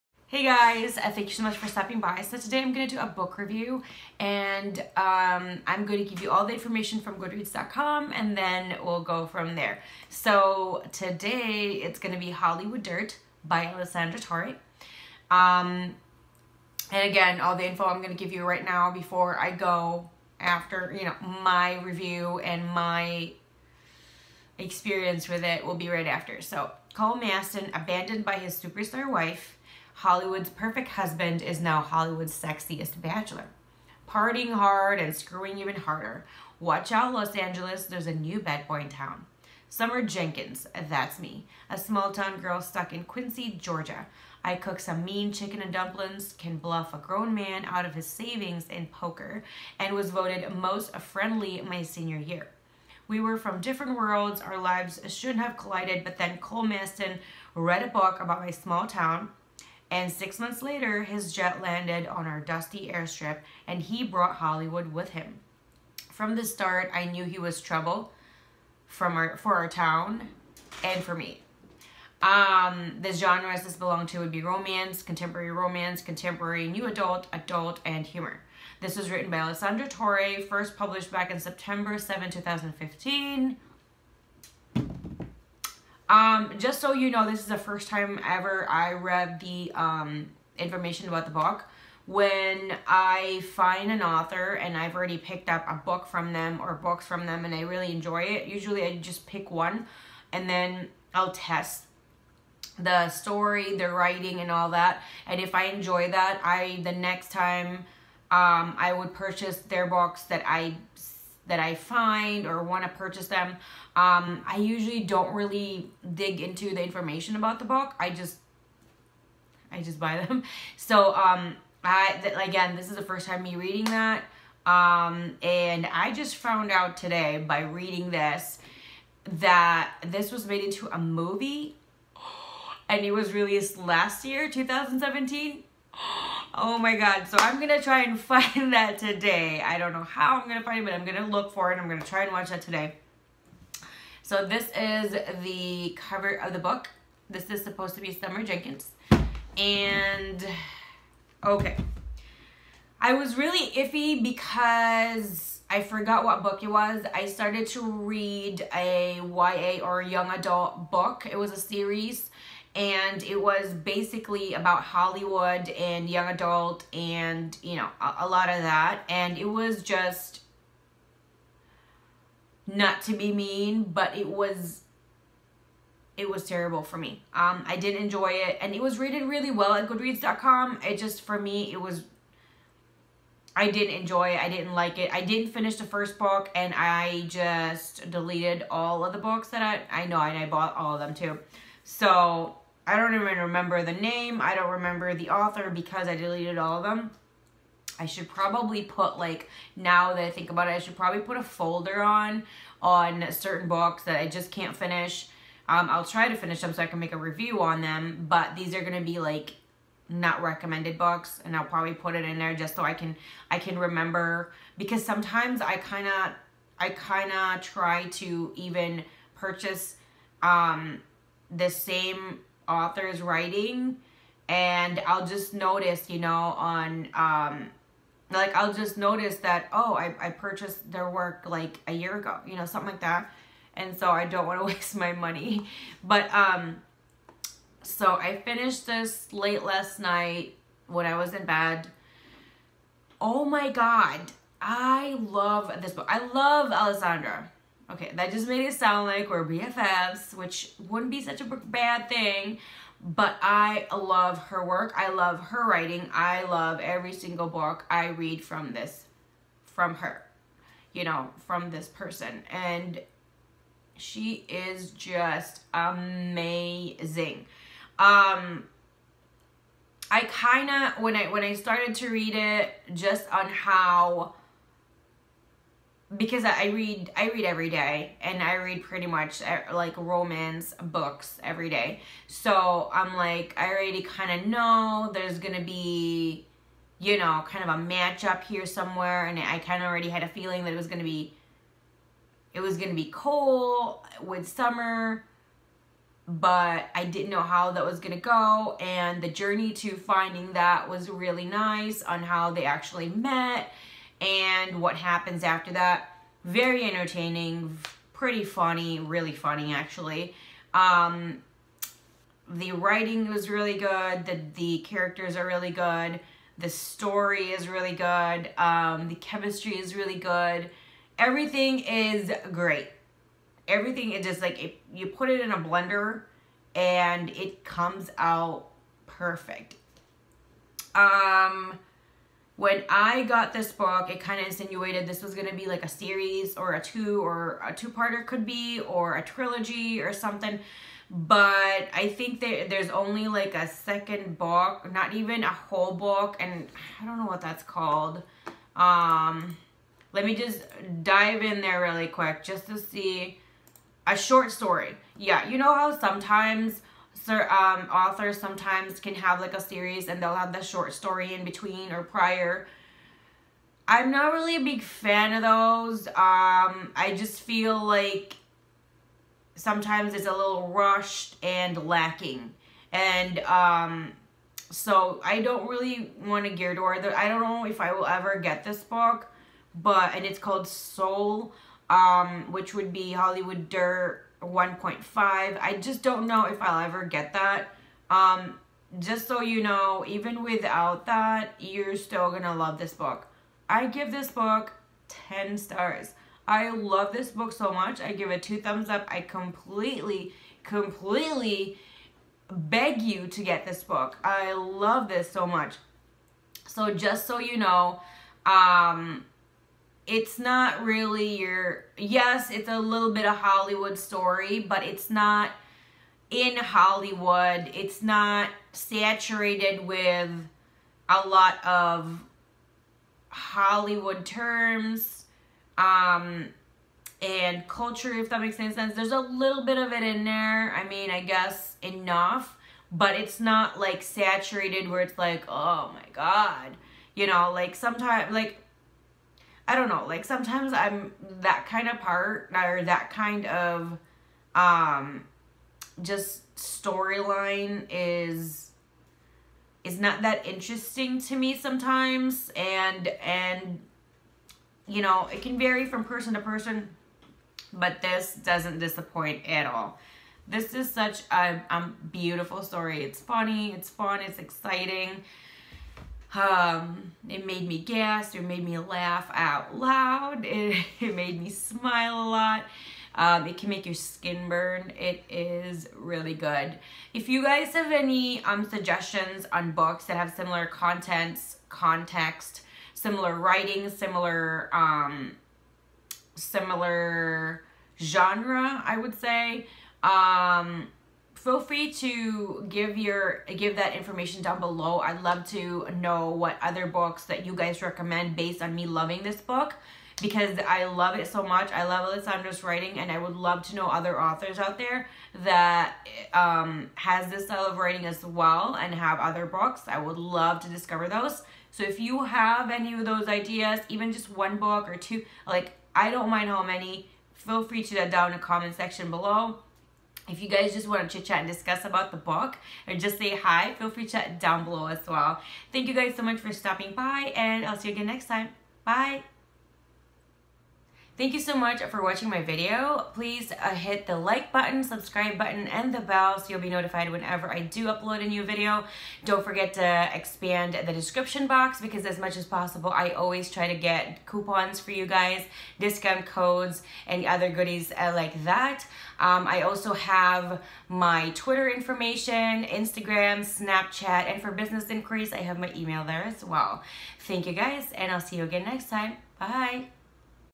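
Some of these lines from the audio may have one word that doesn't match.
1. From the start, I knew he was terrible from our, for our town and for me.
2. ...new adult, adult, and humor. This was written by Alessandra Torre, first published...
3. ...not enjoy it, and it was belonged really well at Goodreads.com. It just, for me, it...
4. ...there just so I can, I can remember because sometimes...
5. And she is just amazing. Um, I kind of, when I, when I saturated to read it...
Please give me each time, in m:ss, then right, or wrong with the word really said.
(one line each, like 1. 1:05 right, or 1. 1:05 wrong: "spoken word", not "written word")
1. 1:06 wrong: "trouble", not "terrible"
2. 1:16 right
3. 2:57 wrong: "rated", not "belonged"
4. 3:32 right
5. 4:22 wrong: "started", not "saturated".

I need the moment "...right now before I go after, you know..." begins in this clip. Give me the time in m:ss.
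0:18.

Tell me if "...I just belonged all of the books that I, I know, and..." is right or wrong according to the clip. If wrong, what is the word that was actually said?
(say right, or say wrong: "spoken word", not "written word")
wrong: "deleted", not "belonged".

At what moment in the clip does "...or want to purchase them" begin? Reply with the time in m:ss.
1:52.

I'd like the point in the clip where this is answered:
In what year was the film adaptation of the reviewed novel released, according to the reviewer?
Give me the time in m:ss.
2:14.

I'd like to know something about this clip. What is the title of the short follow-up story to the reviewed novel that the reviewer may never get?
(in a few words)
Soul.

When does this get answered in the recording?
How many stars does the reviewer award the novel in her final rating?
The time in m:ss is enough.
6:35.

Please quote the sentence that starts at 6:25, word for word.
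I just don't know if I'll ever get that.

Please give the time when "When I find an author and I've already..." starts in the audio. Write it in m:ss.
1:32.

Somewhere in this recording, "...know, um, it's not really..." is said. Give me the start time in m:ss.
6:47.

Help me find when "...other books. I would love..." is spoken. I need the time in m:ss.
8:29.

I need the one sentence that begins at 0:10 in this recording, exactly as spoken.
So today it's going to be Hollywood Dirt by Alessandra Torre.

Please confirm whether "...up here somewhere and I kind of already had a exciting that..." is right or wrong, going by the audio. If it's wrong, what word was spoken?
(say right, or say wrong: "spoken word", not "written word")
wrong: "feeling", not "exciting".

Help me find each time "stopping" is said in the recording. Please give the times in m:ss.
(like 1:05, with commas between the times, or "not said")
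0:01, 8:46.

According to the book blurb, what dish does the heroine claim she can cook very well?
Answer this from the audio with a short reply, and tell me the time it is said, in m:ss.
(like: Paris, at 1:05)
chicken and dumplings, at 0:45.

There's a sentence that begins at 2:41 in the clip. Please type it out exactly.
It was a series and it was basically about Hollywood and young adult and, you know, a, a lot of that.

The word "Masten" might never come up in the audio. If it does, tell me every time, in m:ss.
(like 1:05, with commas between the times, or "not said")
0:27, 0:56.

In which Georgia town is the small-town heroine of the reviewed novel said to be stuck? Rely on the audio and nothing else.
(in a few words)
Quincy.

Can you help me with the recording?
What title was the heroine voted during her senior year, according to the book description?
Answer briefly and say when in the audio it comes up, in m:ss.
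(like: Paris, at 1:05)
most friendly, at 0:50.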